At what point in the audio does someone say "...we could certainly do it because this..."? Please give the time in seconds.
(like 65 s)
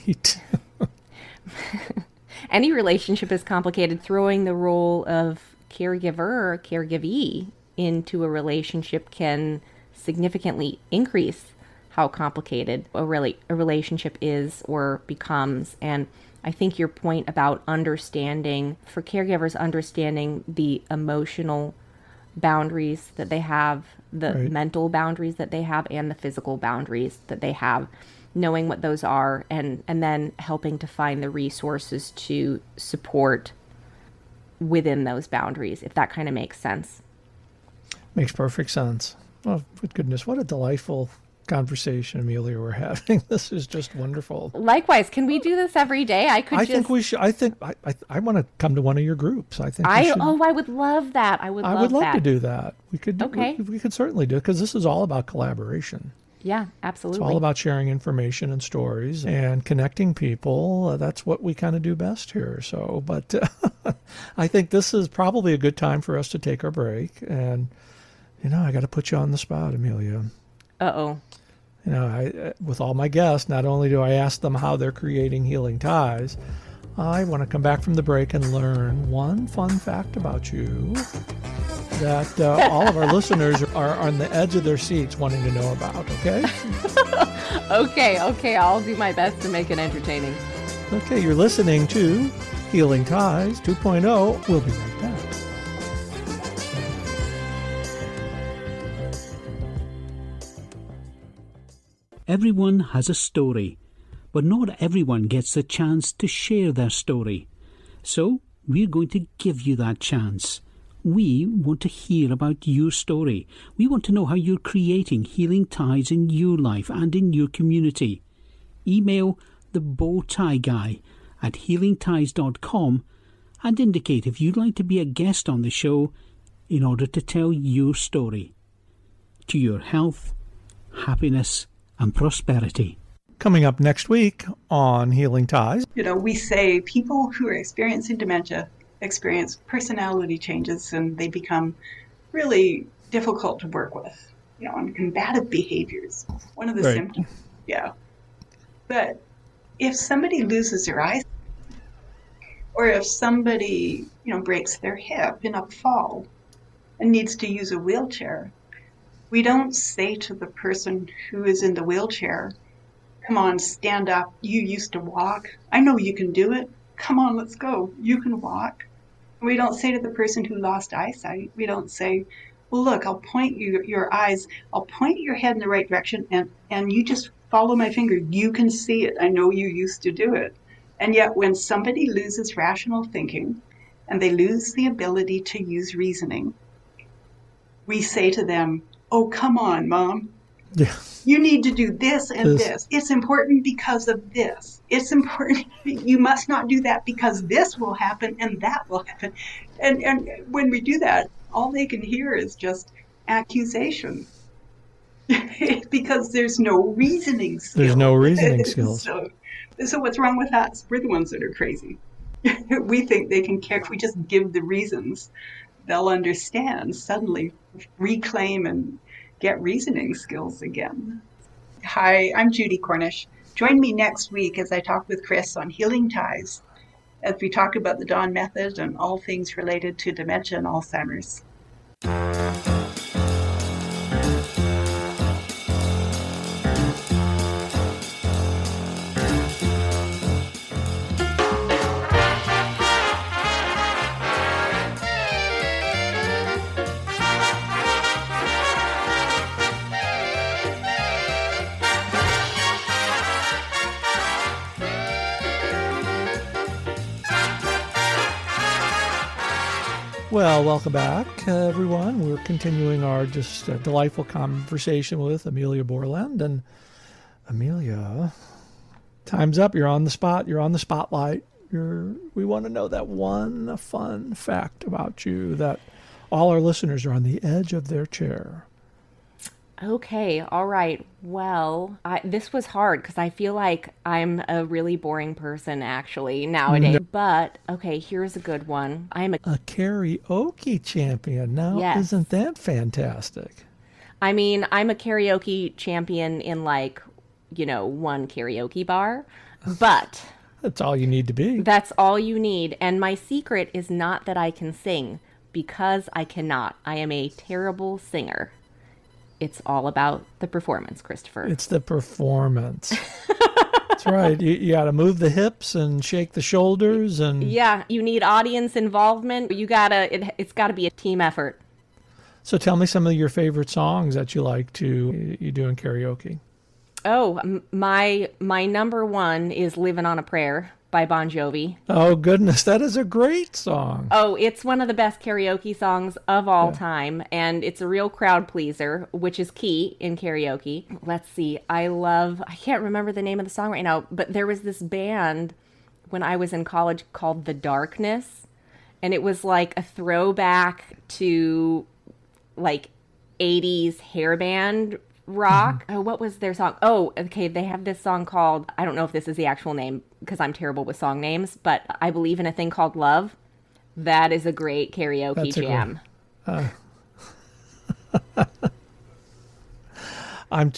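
53 s.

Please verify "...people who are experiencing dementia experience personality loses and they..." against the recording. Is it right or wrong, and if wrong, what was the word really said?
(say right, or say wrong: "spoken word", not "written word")
wrong: "changes", not "loses".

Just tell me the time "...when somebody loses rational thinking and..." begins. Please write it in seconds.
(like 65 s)
181 s.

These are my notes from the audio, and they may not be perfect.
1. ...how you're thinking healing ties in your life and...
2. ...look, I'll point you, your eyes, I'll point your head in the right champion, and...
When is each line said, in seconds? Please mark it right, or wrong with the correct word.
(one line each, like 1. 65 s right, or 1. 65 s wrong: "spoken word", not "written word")
1. 114 s wrong: "creating", not "thinking"
2. 172 s wrong: "direction", not "champion".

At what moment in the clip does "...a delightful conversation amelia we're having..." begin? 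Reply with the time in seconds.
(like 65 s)
40 s.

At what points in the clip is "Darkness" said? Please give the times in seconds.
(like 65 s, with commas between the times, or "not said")
347 s.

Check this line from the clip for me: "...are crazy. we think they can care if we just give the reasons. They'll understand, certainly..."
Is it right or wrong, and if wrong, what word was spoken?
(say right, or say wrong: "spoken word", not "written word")
wrong: "suddenly", not "certainly".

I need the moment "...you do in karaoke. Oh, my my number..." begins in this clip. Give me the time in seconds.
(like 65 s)
325 s.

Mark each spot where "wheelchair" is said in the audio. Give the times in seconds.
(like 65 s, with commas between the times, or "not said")
157 s, 161 s.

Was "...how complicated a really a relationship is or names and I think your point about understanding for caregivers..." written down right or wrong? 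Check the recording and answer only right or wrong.
wrong.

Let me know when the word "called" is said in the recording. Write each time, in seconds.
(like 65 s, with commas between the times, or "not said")
347 s, 358 s, 362 s.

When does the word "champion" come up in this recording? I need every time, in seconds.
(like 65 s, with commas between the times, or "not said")
290 s, 295 s.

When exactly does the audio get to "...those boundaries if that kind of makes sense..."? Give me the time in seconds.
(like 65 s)
35 s.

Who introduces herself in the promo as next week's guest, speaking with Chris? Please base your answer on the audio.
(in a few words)
Judy Cornish.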